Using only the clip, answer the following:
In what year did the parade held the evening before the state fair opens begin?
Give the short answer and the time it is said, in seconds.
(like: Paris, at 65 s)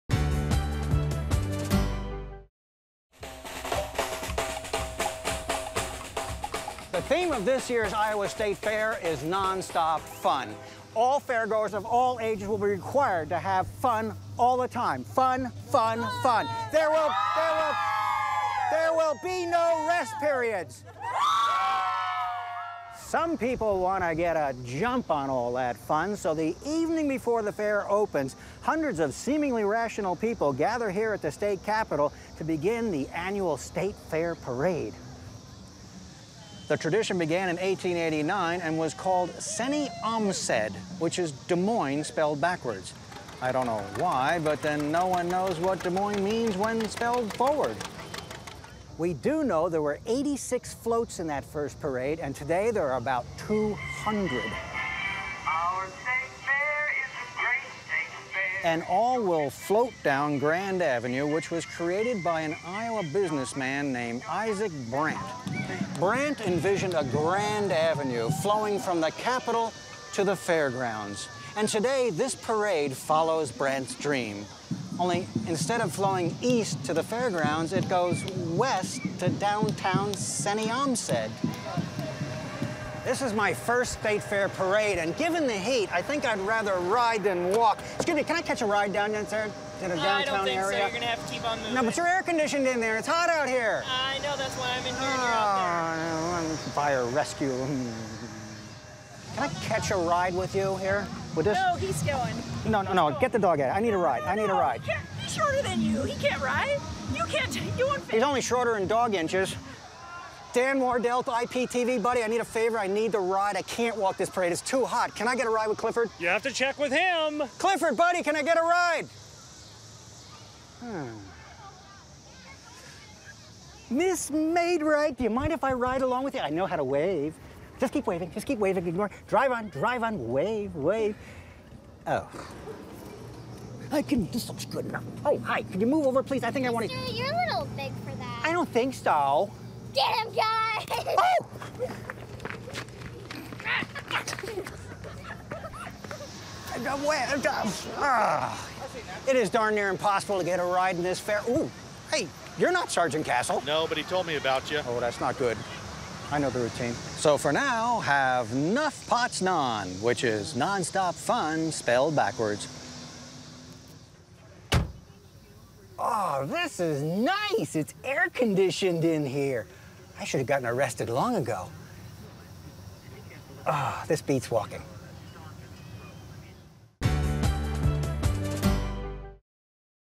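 1889, at 37 s.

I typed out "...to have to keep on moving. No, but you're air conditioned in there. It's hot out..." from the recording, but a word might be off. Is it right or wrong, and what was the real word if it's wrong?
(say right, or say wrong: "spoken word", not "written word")
right.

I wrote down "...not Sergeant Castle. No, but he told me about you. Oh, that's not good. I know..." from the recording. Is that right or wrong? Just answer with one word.
right.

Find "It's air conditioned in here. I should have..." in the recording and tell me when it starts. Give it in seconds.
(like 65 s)
167 s.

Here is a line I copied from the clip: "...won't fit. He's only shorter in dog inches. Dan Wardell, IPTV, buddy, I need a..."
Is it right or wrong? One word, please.
right.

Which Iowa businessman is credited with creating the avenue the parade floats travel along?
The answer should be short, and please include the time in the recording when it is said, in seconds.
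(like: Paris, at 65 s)
Isaac Brandt, at 64 s.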